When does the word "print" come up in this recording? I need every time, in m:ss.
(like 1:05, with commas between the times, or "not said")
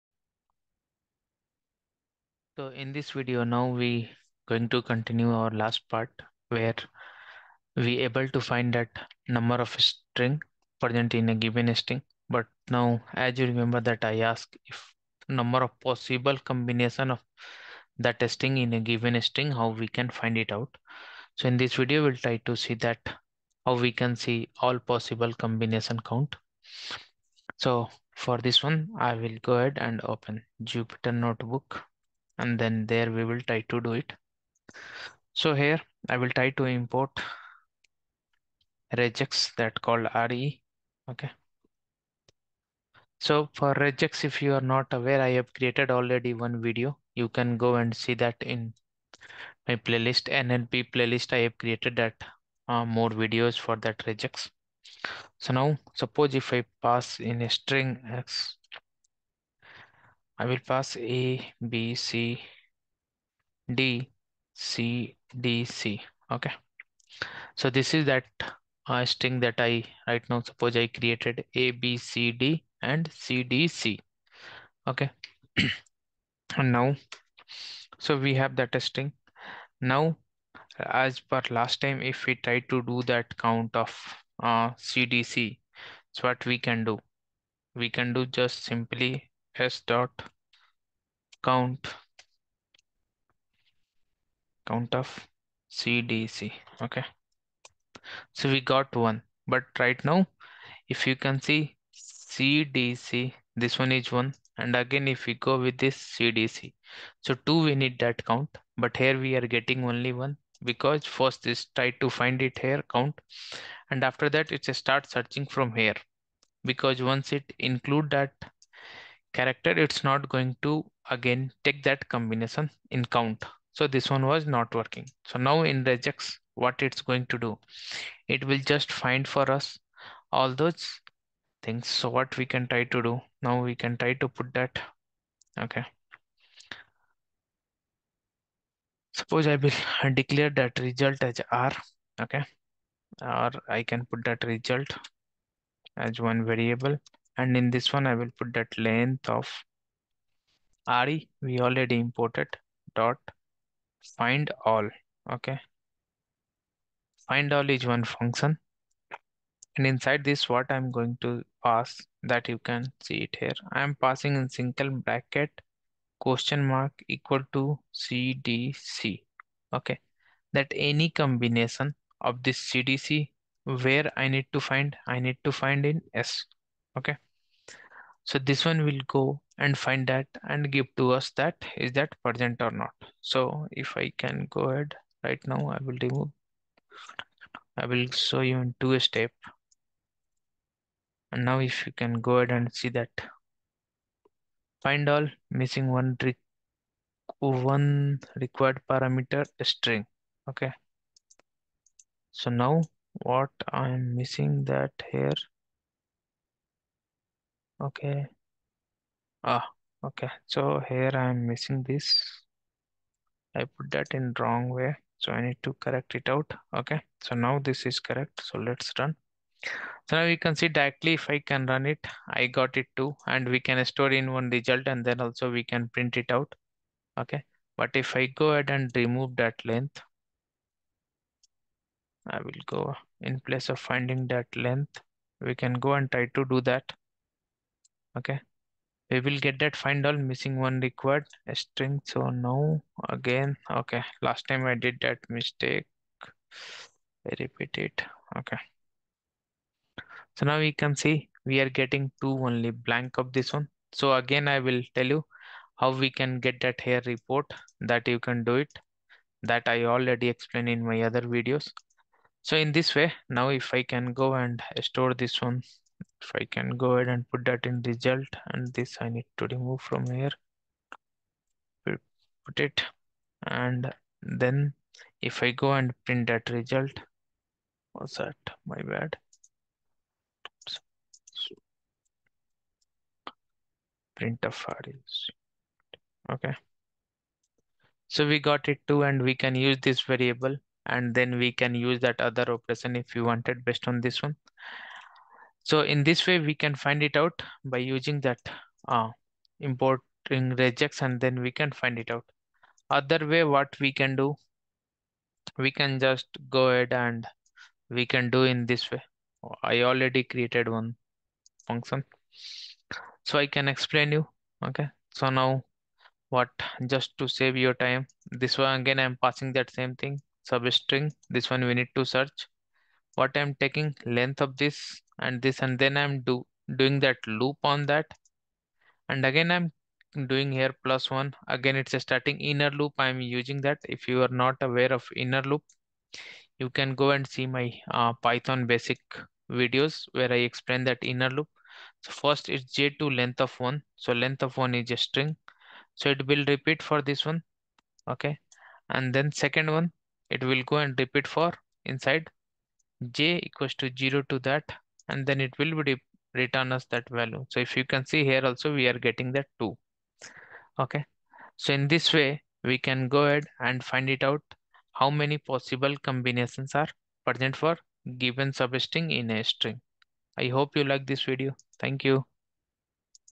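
3:45, 4:36, 4:44.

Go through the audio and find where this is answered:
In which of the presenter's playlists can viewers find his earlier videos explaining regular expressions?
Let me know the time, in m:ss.
0:50.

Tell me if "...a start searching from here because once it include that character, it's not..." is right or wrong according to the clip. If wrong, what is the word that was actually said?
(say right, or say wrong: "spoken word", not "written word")
right.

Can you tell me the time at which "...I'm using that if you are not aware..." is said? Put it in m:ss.
5:32.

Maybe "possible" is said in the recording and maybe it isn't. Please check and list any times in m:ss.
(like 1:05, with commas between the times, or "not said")
0:15, 0:24, 6:05.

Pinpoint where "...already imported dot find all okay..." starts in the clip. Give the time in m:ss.
2:31.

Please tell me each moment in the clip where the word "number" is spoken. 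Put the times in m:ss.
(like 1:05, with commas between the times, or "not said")
0:09, 0:15.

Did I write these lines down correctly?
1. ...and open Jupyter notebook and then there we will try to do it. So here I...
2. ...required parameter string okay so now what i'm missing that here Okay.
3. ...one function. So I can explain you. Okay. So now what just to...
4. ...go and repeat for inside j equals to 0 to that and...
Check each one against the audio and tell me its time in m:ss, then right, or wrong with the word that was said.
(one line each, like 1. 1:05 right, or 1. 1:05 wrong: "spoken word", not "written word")
1. 0:29 right
2. 3:18 right
3. 5:10 right
4. 5:50 right.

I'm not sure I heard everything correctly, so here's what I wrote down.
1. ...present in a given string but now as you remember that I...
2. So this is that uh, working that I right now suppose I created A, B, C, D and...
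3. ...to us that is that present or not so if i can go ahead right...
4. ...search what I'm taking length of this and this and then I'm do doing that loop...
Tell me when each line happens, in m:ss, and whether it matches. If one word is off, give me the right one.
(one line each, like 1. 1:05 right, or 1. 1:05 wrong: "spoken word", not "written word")
1. 0:10 right
2. 1:07 wrong: "string", not "working"
3. 3:00 right
4. 5:22 right.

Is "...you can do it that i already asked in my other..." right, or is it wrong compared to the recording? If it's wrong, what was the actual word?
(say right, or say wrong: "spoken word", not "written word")
wrong: "explained", not "asked".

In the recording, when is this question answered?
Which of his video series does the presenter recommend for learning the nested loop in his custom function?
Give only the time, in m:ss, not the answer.
5:38.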